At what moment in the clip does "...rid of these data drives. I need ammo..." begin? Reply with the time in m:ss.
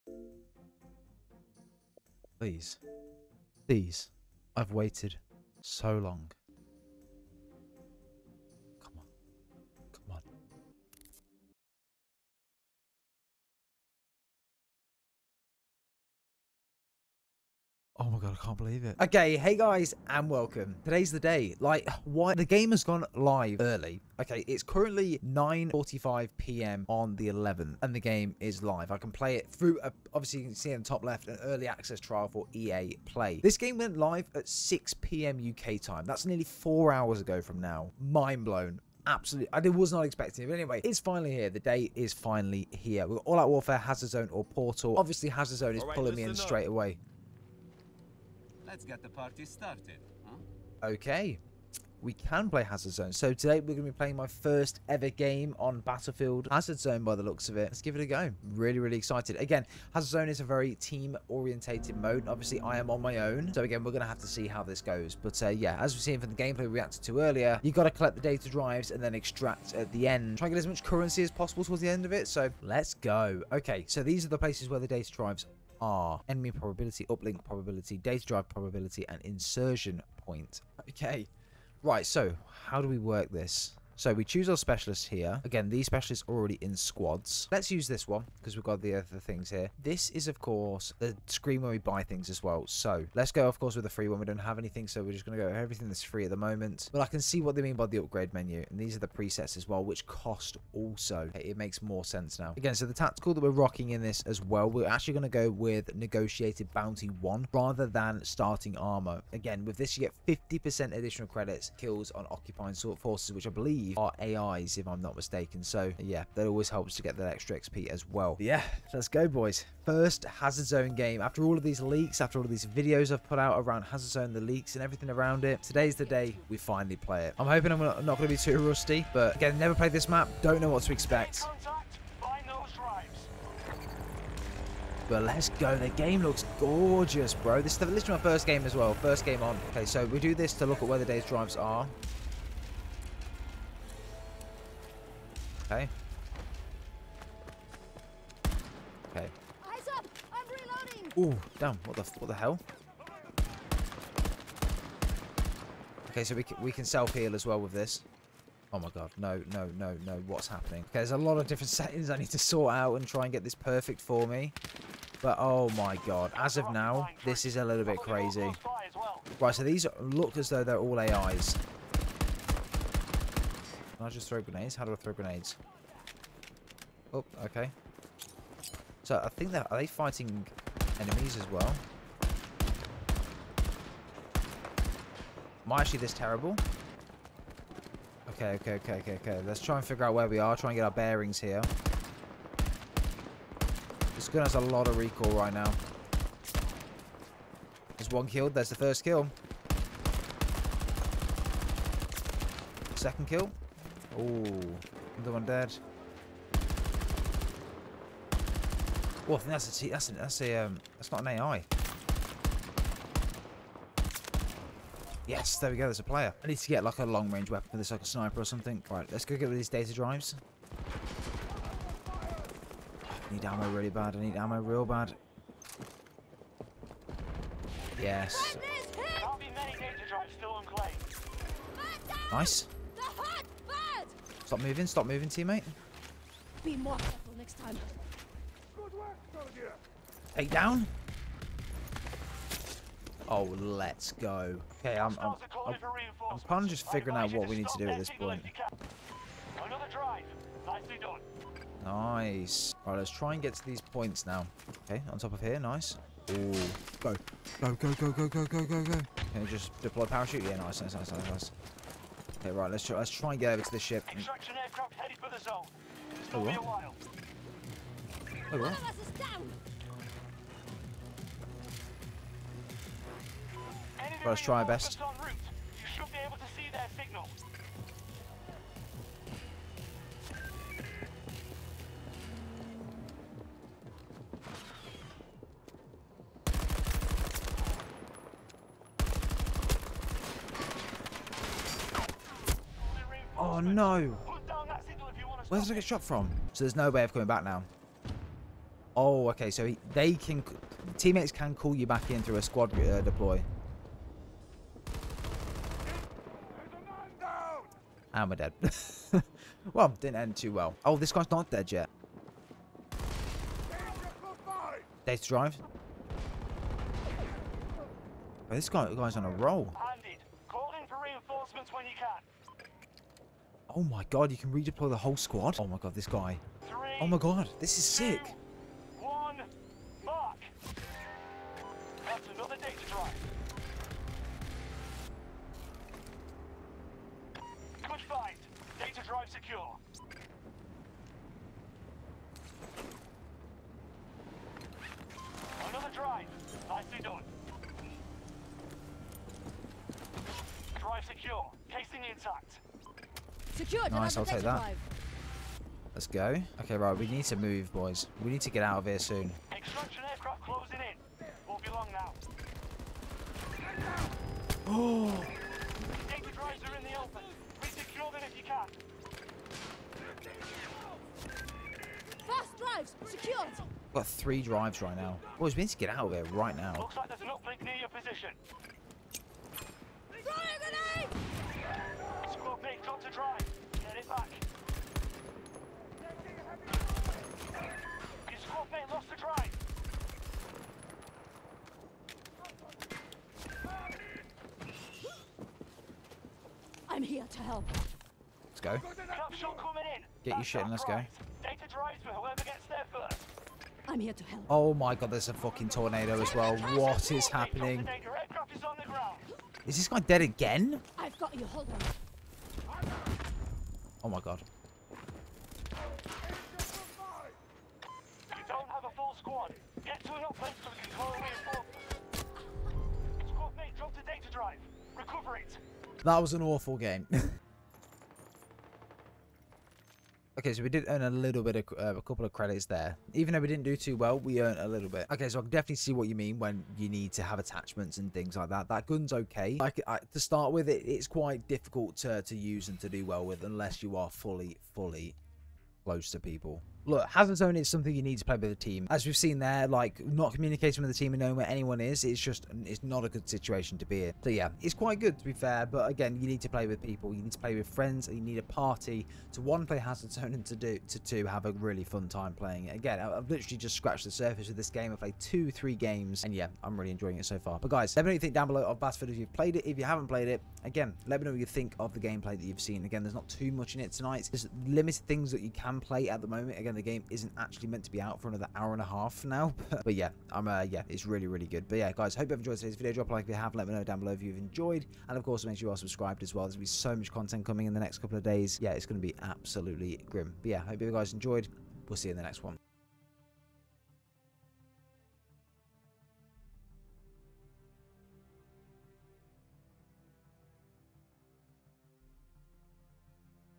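3:39.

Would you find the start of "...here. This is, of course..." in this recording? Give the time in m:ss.
1:29.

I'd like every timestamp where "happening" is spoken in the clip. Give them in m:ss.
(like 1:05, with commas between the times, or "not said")
2:40, 6:47.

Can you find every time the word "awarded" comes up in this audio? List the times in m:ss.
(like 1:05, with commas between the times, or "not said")
not said.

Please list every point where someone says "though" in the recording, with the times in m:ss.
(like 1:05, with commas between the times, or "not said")
2:50, 7:13.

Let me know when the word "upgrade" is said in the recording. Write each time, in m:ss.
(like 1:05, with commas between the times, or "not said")
1:37.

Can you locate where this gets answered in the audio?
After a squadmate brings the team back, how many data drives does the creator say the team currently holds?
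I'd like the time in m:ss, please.
6:14.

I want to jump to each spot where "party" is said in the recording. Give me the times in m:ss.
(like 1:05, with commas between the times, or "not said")
0:49, 7:38.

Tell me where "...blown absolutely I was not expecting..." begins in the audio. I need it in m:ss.
0:38.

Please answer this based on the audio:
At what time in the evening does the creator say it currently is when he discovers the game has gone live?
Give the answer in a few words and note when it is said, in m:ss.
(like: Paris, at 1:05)
9:45 p.m., at 0:25.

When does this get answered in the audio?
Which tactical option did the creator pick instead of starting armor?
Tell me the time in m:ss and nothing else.
1:45.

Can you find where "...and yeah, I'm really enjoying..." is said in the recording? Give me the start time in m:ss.
7:46.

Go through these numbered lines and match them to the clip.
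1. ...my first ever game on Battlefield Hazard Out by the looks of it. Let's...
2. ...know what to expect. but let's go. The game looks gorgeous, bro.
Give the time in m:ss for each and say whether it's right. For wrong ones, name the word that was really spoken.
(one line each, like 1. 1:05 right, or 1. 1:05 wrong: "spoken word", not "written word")
1. 0:54 wrong: "Zone", not "Out"
2. 2:10 right.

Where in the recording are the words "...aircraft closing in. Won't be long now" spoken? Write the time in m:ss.
6:00.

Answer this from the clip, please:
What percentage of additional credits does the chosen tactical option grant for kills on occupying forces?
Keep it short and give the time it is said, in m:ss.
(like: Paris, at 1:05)
50%, at 1:50.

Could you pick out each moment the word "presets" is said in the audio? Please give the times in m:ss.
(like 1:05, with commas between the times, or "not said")
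1:39.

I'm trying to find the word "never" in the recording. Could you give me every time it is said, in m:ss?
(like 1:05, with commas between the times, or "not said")
2:09.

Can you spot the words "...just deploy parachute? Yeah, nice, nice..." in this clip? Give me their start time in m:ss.
4:19.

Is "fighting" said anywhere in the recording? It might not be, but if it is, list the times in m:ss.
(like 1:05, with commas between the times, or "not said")
2:59.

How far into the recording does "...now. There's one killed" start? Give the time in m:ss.
3:15.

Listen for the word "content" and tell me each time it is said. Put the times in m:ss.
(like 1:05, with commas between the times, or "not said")
8:07.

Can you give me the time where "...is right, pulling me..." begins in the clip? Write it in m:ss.
0:45.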